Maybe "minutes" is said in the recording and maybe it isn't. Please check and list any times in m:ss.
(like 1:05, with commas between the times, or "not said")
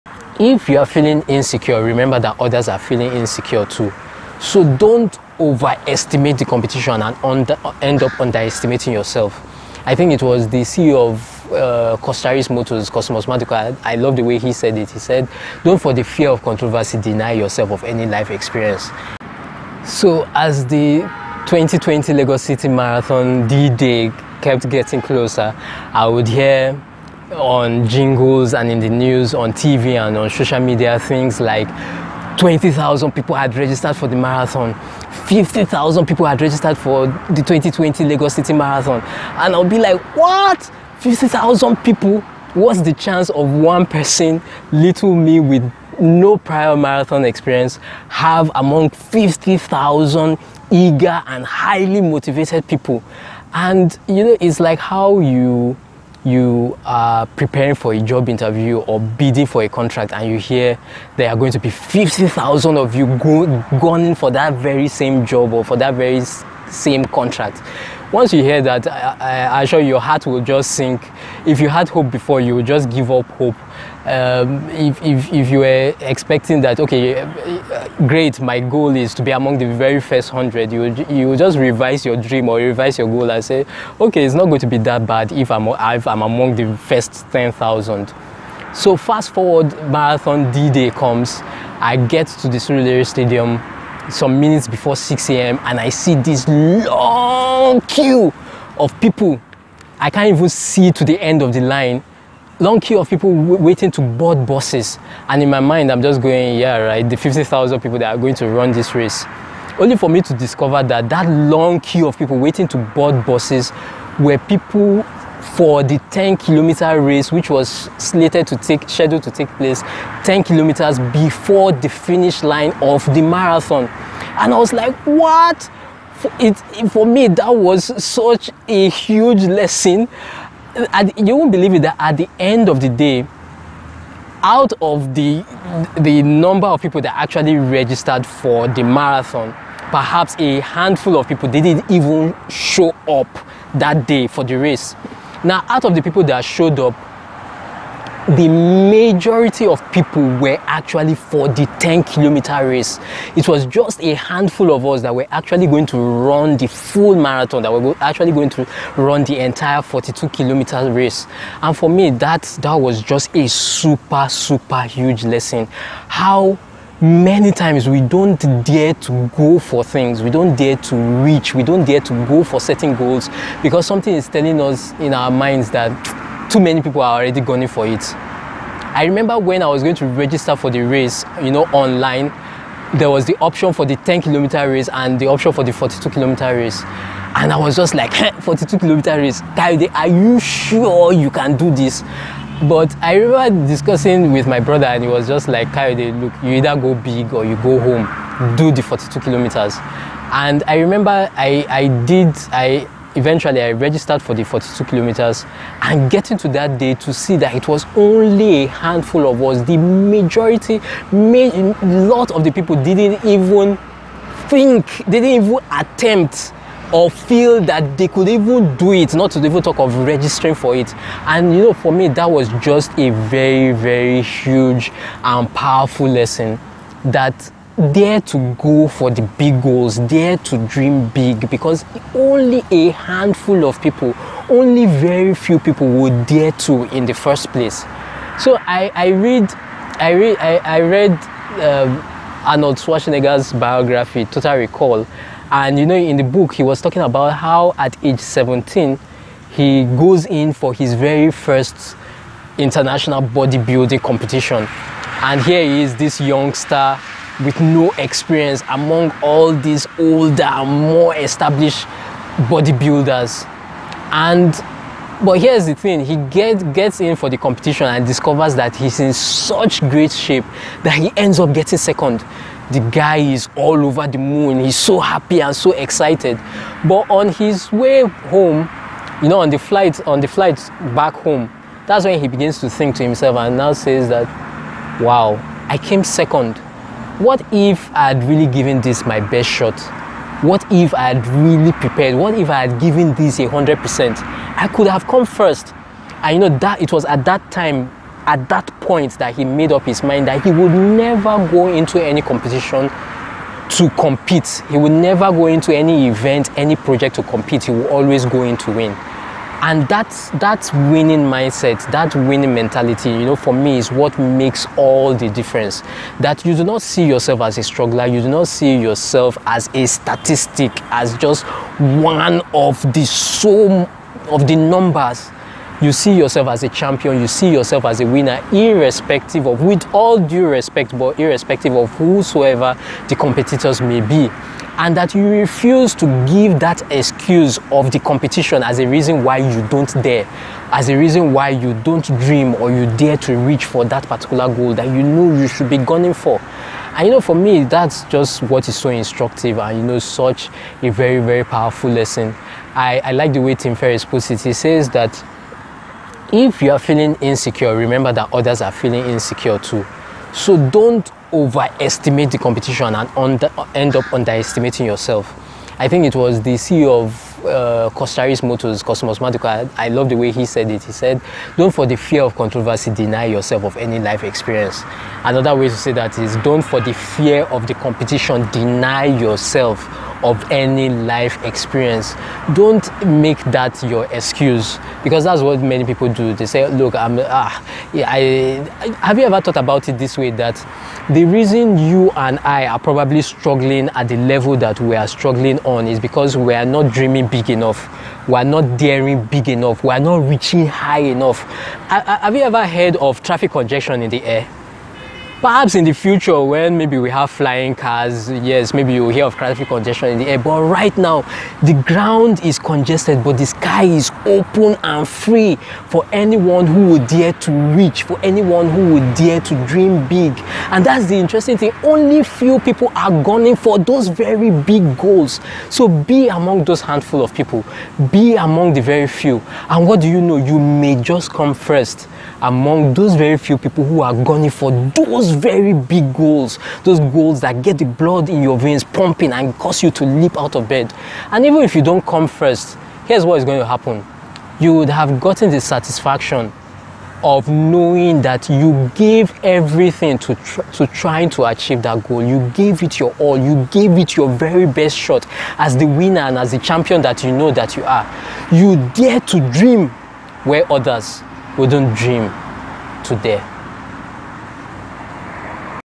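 1:34.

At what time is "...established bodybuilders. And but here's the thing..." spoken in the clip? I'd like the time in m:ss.
4:21.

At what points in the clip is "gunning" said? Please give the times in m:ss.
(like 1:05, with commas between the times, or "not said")
2:57, 5:45, 7:03, 7:14.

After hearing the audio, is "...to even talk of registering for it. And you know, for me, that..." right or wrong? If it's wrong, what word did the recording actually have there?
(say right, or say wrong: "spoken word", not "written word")
right.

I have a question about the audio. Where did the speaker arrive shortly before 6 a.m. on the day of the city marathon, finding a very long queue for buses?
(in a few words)
Surulere Stadium.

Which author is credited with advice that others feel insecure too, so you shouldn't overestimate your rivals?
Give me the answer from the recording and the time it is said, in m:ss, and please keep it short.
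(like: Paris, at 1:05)
Tim Ferriss, at 5:53.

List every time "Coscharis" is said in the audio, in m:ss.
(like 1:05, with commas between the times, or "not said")
0:12, 6:07.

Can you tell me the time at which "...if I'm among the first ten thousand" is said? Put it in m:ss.
1:25.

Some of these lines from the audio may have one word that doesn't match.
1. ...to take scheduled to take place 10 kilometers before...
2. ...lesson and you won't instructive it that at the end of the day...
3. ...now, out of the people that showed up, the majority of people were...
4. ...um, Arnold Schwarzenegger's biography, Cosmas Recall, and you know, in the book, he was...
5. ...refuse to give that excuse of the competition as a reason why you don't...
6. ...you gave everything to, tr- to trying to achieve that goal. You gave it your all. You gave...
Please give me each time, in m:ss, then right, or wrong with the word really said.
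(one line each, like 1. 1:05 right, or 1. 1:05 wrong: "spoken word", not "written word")
1. 1:58 right
2. 2:09 wrong: "believe", not "instructive"
3. 2:25 right
4. 4:01 wrong: "Total", not "Cosmas"
5. 5:35 right
6. 7:28 right.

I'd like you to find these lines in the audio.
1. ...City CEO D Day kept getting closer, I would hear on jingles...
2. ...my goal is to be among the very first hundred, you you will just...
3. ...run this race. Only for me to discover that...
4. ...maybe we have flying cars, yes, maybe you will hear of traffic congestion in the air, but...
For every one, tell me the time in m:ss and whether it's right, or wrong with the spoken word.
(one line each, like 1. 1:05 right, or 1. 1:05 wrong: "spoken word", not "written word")
1. 0:22 wrong: "Marathon", not "CEO"
2. 1:18 right
3. 1:48 right
4. 6:46 right.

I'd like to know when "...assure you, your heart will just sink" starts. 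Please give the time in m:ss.
1:09.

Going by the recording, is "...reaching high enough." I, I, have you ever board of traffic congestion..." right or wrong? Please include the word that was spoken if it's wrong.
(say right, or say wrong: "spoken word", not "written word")
wrong: "heard", not "board".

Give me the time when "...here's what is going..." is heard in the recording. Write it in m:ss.
7:23.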